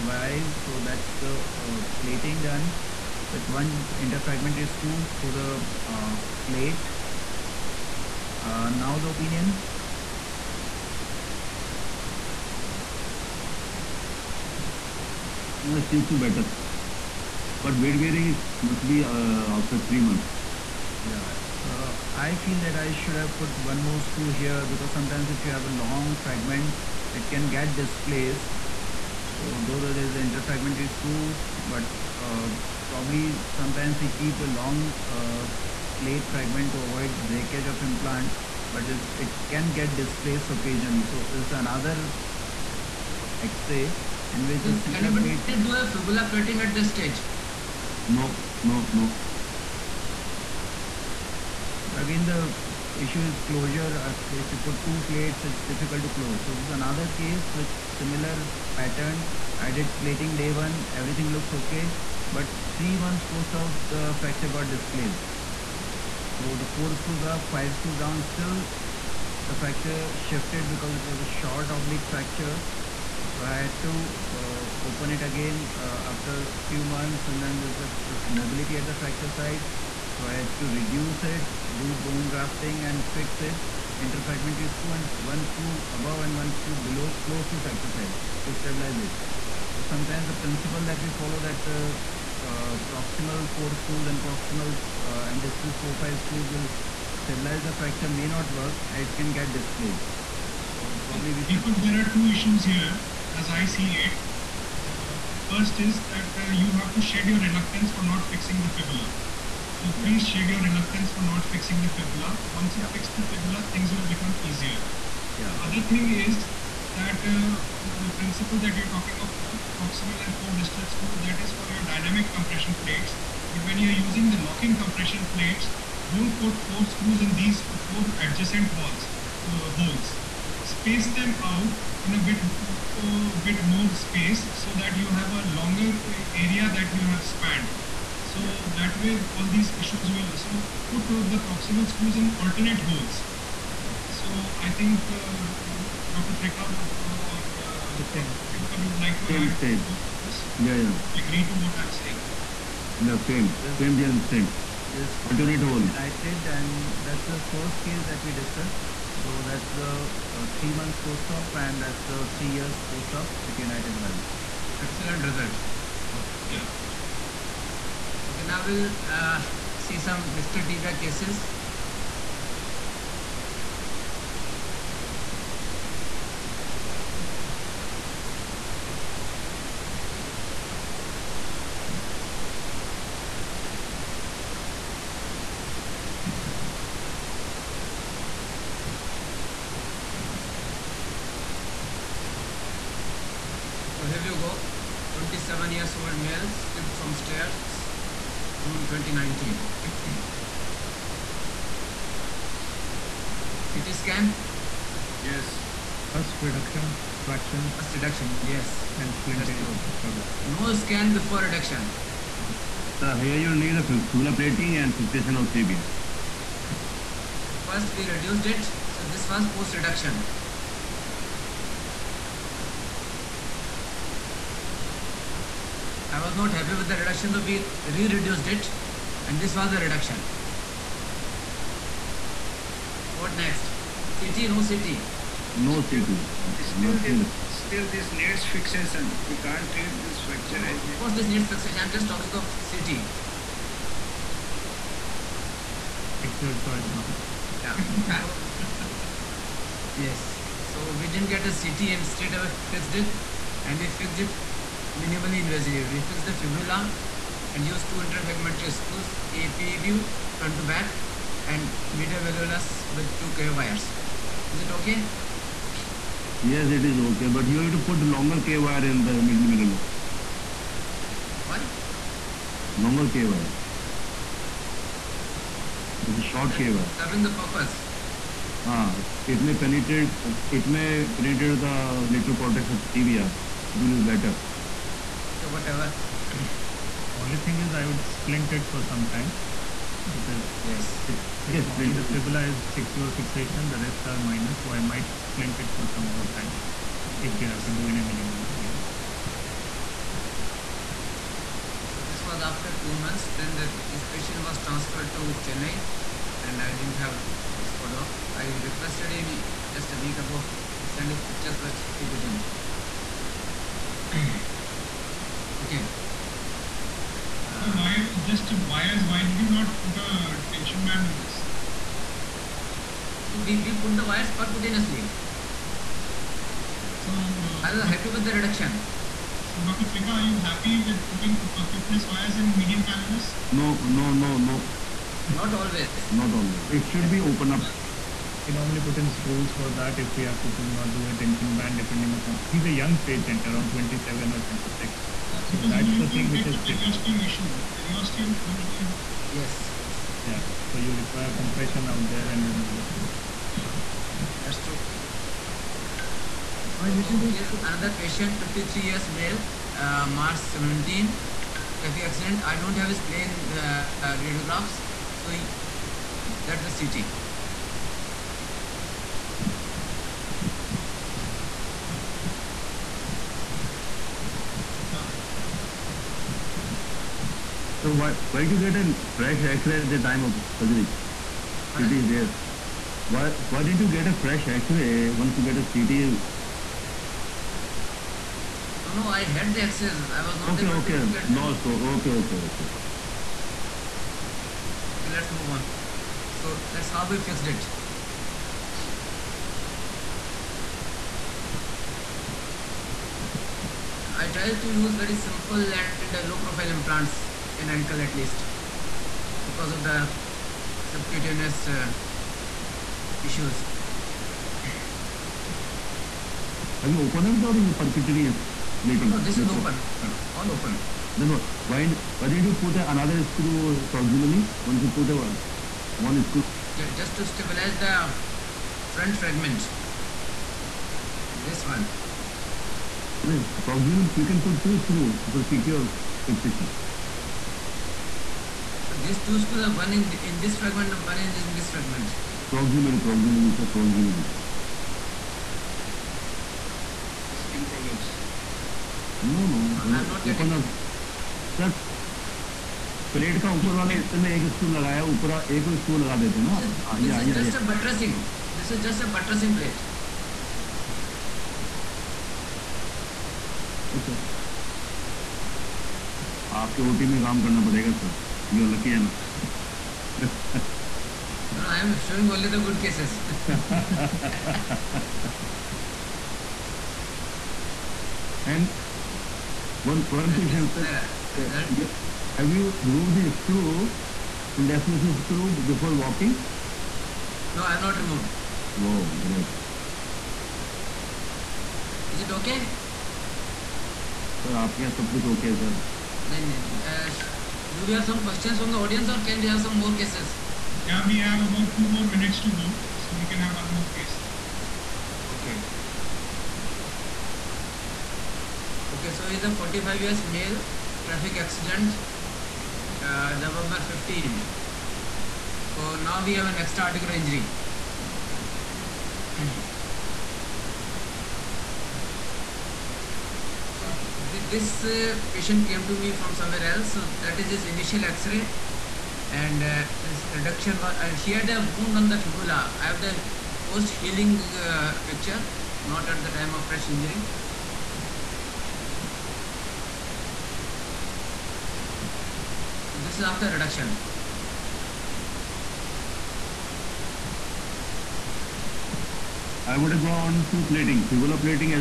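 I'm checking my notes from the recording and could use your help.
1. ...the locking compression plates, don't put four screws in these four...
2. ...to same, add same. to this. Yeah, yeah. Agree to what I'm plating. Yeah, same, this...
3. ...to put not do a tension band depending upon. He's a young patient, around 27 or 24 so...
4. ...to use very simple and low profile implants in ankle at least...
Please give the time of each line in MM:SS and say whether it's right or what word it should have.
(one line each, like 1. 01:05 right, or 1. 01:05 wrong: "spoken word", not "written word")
1. 02:04 right
2. 02:29 wrong: "saying", not "plating"
3. 05:40 wrong: "26", not "24"
4. 06:44 right.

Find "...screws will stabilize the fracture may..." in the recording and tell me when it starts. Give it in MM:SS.
01:36.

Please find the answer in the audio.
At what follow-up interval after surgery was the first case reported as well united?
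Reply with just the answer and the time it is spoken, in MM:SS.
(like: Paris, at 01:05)
3 years, at 02:42.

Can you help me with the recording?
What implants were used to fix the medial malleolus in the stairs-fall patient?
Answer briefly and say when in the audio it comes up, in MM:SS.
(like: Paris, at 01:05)
two K wires, at 04:23.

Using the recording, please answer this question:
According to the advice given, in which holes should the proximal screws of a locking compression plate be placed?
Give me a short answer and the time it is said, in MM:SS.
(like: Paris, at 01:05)
alternate holes, at 02:22.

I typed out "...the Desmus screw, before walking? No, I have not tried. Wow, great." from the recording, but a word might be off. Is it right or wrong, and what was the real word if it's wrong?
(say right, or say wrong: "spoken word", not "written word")
wrong: "removed", not "tried".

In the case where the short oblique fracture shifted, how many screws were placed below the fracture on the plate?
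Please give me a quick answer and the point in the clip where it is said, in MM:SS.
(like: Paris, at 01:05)
5, at 01:07.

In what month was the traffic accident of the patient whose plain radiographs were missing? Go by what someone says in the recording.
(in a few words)
March.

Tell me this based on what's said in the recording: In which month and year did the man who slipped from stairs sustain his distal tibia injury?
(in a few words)
June 2019.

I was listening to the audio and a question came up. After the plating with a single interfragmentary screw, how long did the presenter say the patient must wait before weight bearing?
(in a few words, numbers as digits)
3 months.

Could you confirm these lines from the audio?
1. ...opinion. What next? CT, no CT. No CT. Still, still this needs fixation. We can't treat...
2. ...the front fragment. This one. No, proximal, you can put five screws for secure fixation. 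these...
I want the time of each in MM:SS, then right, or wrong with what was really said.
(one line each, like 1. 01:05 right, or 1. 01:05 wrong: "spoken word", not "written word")
1. 03:49 wrong: "reduction", not "opinion"
2. 07:07 wrong: "two", not "five".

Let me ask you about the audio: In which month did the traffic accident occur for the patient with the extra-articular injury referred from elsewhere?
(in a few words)
November.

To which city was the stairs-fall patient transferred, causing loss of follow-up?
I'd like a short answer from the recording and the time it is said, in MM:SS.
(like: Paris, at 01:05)
Chennai, at 05:05.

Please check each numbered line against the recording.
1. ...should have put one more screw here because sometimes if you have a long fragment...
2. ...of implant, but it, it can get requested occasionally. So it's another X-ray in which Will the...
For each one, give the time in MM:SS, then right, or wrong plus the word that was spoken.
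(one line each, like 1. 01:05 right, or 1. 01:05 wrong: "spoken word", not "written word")
1. 00:22 right
2. 00:37 wrong: "displaced", not "requested".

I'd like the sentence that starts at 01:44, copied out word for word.
Uh, first is that uh, you have to shed your reluctance for not fixing the fibula so yeah.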